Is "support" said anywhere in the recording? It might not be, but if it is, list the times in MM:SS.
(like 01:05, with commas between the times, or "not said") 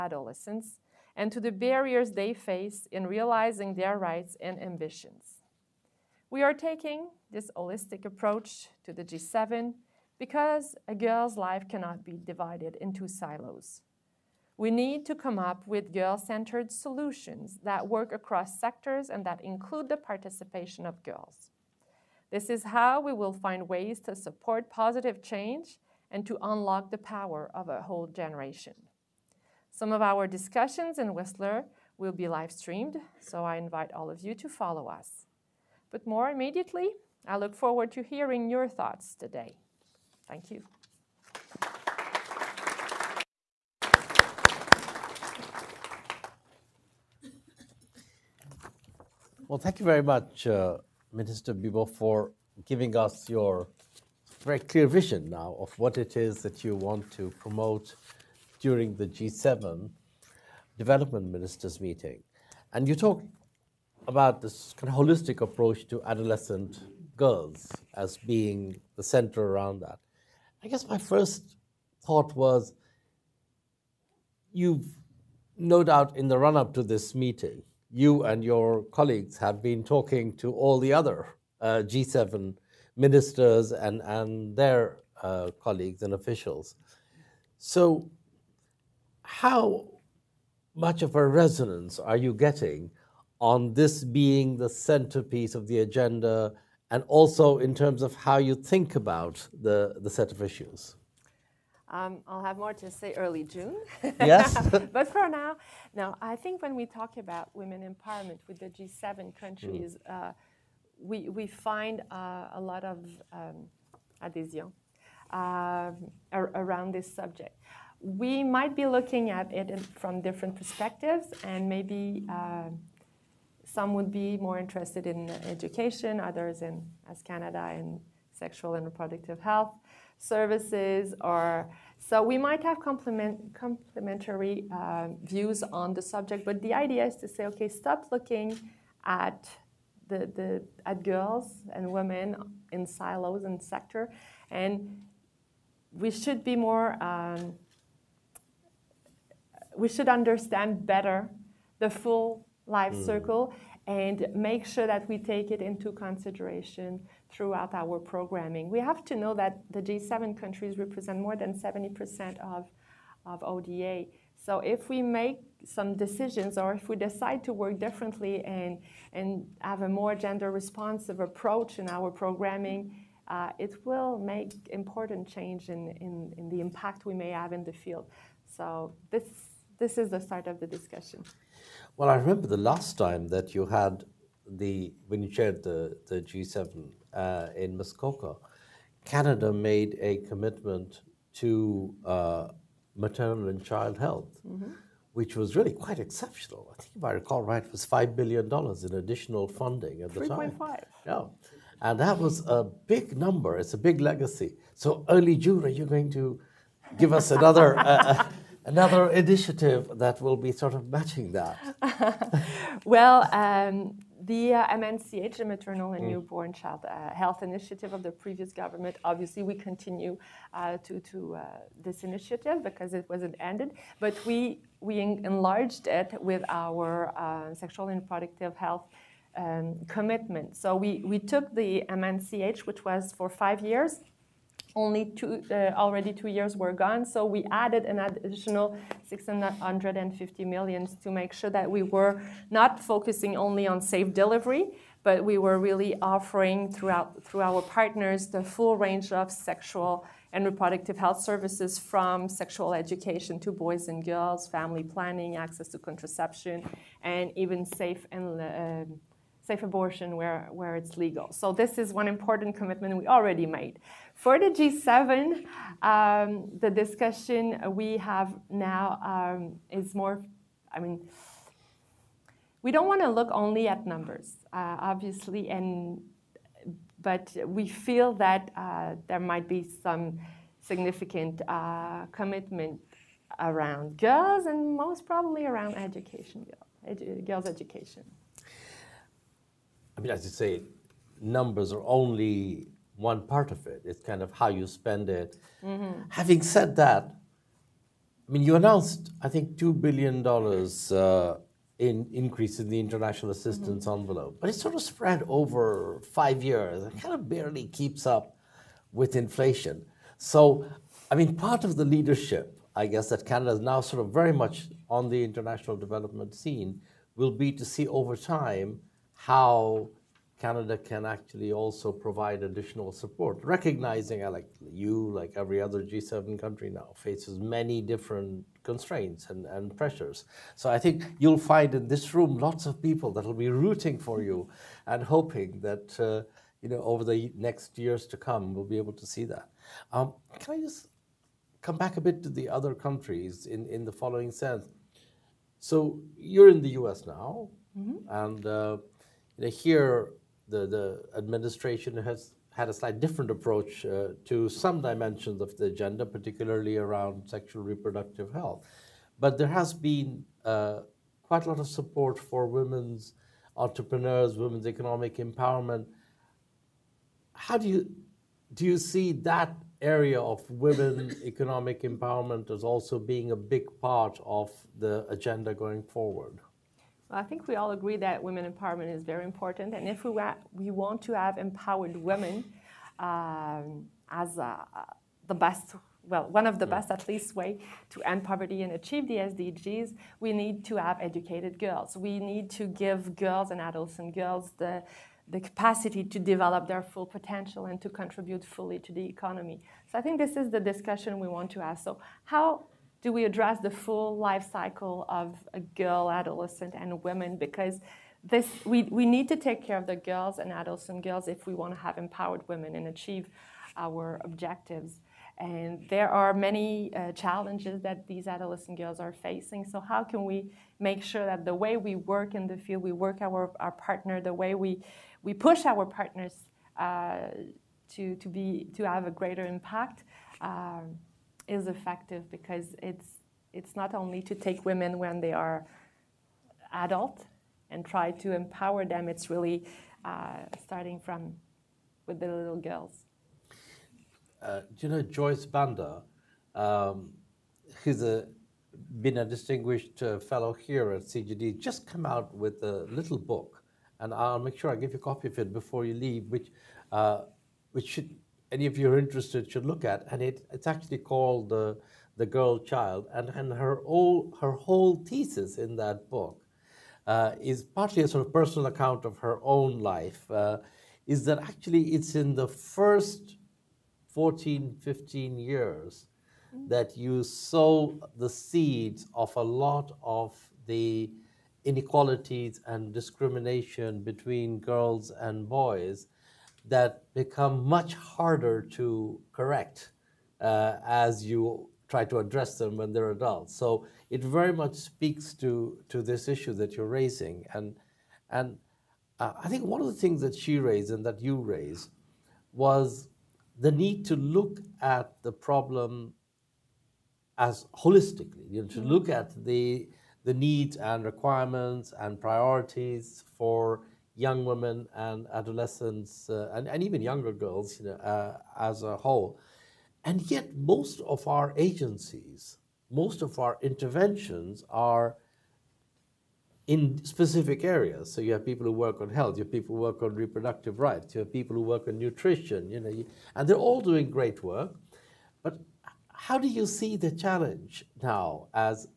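00:24, 05:22, 06:01.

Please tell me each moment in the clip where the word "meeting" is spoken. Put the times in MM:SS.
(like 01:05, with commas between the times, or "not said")
01:01, 01:17.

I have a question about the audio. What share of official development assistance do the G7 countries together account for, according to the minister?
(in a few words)
more than 70%.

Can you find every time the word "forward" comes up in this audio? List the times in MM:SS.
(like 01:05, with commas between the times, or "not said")
00:37, 06:15.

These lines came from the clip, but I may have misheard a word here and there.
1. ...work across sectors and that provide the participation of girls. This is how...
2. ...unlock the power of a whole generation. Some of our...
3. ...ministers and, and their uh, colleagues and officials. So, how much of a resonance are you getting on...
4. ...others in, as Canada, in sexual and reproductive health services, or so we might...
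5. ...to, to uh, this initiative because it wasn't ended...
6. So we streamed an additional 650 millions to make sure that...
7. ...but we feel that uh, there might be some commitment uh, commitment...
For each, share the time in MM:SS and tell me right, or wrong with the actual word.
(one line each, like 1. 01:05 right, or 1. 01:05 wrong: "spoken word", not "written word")
1. 00:17 wrong: "include", not "provide"
2. 00:26 right
3. 01:22 right
4. 02:06 right
5. 03:40 right
6. 03:57 wrong: "added", not "streamed"
7. 04:37 wrong: "significant", not "commitment".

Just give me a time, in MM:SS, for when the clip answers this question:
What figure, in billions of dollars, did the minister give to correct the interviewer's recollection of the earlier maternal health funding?
03:20.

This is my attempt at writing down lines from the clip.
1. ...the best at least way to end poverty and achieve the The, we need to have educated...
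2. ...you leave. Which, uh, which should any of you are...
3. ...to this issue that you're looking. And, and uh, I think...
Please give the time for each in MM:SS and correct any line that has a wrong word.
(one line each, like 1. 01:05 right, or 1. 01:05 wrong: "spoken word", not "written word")
1. 06:26 wrong: "SDGs", not "The"
2. 07:35 right
3. 08:15 wrong: "raising", not "looking".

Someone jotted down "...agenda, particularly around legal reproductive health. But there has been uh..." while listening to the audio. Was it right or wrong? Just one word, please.
wrong.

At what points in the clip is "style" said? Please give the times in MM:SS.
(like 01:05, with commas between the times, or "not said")
not said.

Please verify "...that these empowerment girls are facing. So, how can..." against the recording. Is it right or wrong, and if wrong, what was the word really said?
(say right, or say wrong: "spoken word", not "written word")
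wrong: "adolescent", not "empowerment".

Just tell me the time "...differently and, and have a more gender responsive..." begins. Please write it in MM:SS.
02:47.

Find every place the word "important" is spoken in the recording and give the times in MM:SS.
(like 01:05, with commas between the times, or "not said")
02:54, 04:22, 06:19.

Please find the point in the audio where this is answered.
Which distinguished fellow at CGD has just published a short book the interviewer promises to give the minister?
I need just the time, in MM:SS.
07:25.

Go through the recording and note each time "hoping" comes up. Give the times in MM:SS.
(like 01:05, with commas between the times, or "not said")
05:35.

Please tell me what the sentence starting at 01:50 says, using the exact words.
uh, we, we find uh, a lot of um, adhesion uh, ar around this subject.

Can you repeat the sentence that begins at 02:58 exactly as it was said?
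So this, this is the start of the discussion.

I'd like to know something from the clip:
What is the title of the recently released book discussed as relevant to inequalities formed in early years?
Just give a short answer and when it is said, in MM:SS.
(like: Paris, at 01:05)
The Girl Child, at 07:42.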